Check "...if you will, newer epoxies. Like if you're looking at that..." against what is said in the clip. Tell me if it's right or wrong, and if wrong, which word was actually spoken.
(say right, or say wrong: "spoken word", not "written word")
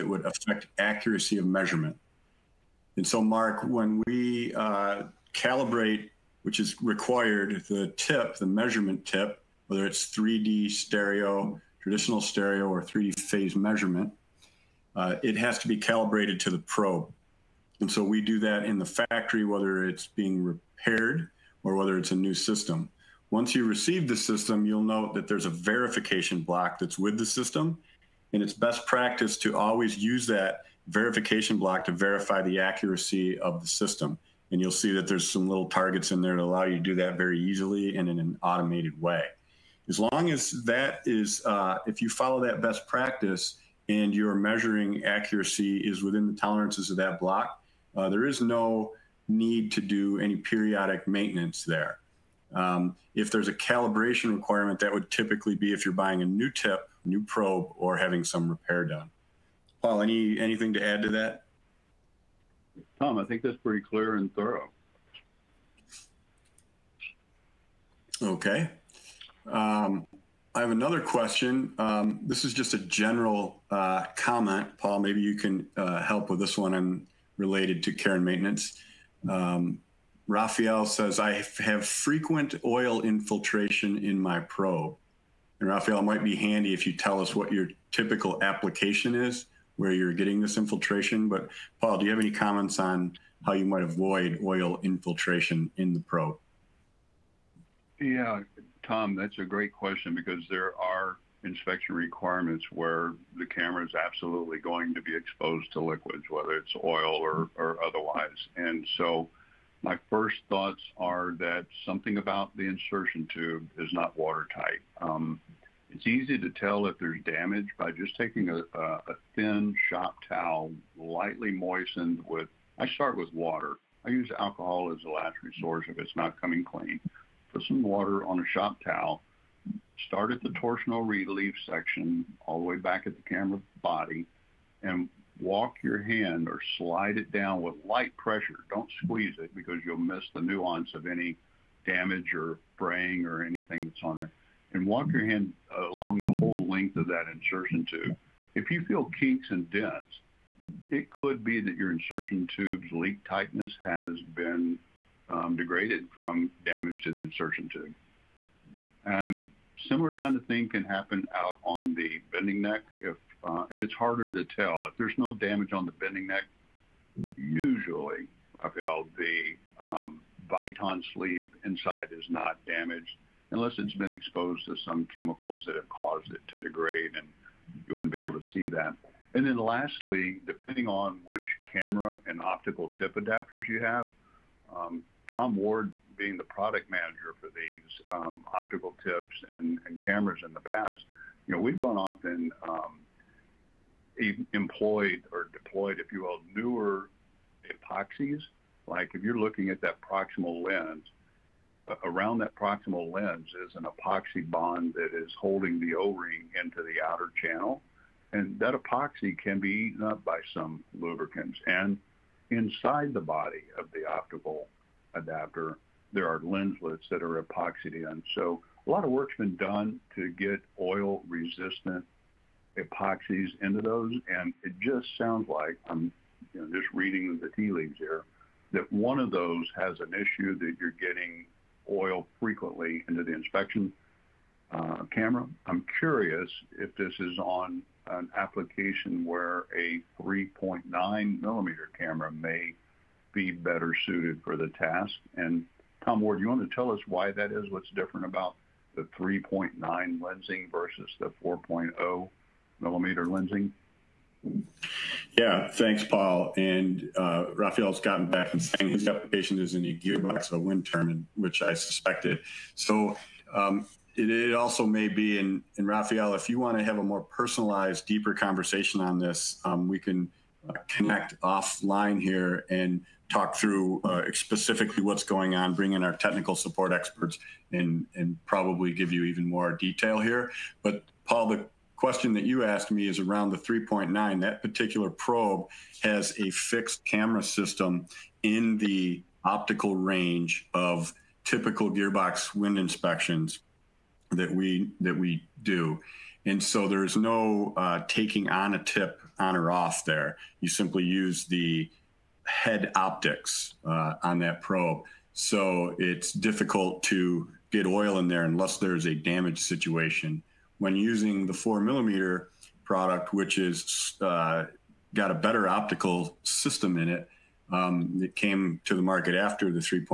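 right.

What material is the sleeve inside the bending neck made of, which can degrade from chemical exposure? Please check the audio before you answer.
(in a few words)
Viton.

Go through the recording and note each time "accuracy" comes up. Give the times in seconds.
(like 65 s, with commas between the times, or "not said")
0 s, 32 s, 45 s.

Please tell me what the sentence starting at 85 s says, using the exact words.
And Raphael, might be handy if you tell us what your typical application is, where you're getting this infiltration.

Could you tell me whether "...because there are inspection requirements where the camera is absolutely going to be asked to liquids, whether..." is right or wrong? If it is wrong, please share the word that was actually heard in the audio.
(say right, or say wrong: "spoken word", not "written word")
wrong: "exposed", not "asked".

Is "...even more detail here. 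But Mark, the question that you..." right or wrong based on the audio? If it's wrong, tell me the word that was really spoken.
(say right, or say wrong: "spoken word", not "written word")
wrong: "Paul", not "Mark".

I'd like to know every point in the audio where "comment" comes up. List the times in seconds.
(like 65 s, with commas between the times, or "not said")
74 s, 92 s.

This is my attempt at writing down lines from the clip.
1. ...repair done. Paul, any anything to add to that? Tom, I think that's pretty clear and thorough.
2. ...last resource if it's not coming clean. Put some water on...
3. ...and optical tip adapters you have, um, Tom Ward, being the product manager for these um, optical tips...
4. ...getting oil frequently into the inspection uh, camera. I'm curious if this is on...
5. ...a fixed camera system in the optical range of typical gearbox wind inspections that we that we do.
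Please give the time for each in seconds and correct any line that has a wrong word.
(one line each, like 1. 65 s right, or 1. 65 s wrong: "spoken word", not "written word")
1. 58 s right
2. 125 s right
3. 182 s right
4. 230 s right
5. 286 s right.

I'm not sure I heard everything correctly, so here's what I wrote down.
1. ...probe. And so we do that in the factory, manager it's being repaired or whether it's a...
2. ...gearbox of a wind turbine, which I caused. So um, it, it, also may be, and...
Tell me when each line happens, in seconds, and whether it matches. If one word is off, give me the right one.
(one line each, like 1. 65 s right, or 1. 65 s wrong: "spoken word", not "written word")
1. 16 s wrong: "whether", not "manager"
2. 259 s wrong: "suspected", not "caused".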